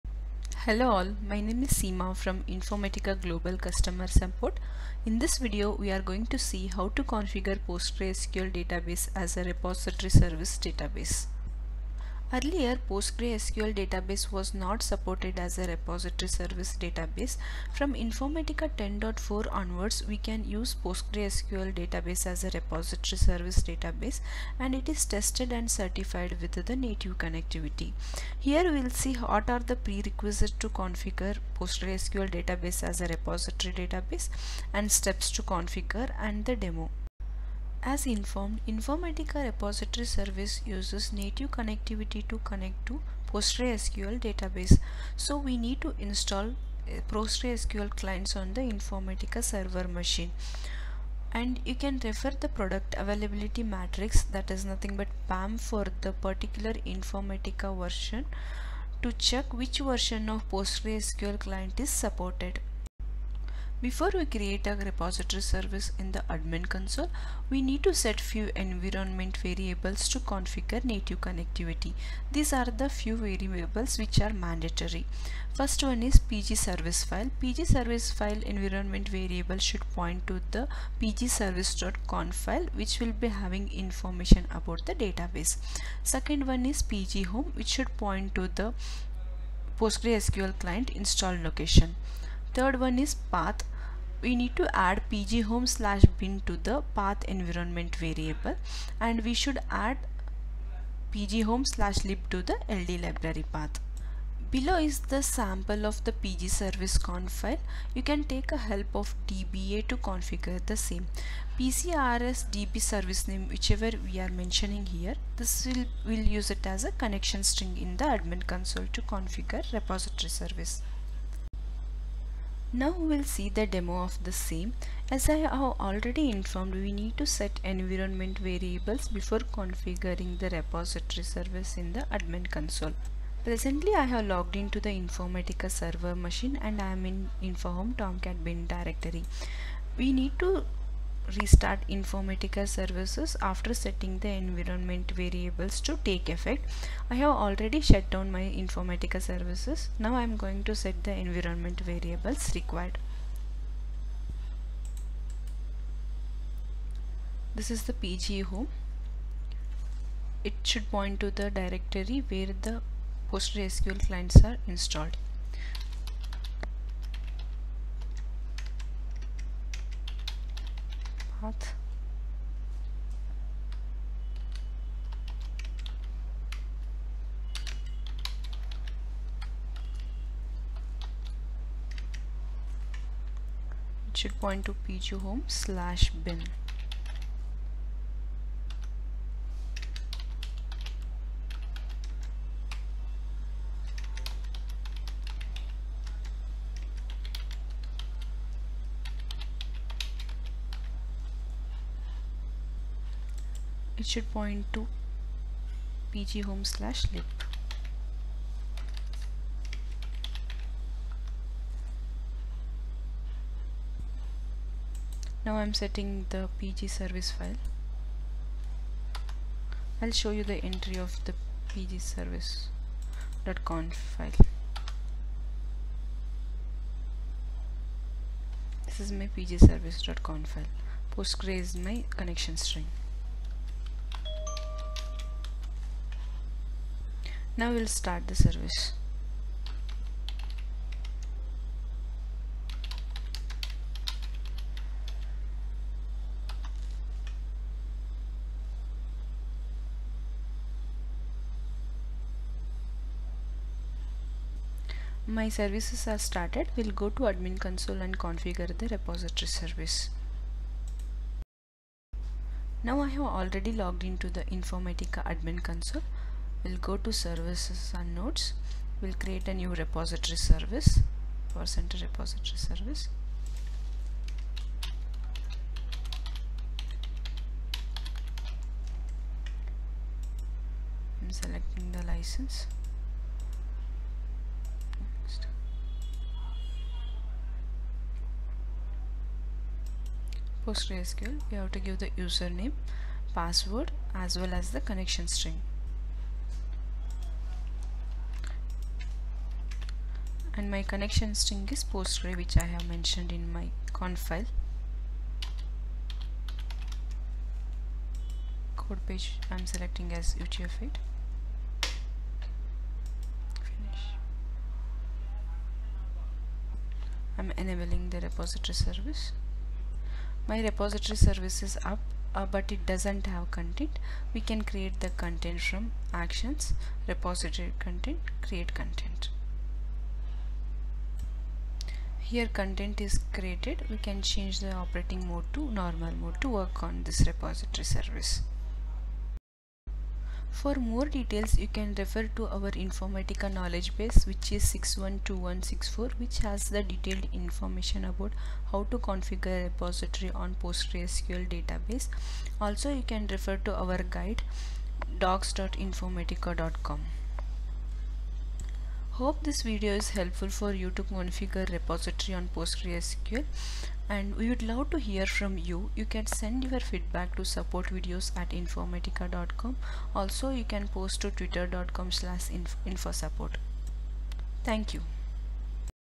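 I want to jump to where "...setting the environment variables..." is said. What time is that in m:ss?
2:23.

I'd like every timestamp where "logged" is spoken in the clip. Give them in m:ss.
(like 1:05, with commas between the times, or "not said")
2:14, 4:23.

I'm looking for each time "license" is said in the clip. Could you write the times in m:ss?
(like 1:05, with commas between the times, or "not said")
4:42.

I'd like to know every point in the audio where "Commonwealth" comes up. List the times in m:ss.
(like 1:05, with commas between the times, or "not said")
not said.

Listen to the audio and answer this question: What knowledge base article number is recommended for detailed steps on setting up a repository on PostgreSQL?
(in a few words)
612164.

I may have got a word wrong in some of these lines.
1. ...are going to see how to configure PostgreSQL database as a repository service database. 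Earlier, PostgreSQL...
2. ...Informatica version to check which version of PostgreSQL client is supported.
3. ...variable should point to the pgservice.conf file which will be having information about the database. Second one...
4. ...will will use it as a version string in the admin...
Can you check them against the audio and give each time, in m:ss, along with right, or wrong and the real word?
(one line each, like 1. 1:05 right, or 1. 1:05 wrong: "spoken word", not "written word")
1. 0:05 right
2. 0:56 right
3. 1:19 right
4. 1:55 wrong: "connection", not "version".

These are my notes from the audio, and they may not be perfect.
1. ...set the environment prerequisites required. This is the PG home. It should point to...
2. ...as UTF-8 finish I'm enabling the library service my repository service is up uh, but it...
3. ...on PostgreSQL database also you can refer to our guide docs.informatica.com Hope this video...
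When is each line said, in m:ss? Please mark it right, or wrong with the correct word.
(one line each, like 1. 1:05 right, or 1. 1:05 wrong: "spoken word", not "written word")
1. 2:30 wrong: "variables", not "prerequisites"
2. 5:10 wrong: "repository", not "library"
3. 5:50 right.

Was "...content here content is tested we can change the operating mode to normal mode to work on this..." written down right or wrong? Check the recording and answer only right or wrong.
wrong.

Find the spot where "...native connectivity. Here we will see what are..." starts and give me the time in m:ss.
0:26.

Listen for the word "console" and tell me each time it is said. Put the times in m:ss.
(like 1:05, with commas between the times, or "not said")
1:06, 1:58, 2:12, 4:17, 4:25.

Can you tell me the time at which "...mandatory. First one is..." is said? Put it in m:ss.
1:14.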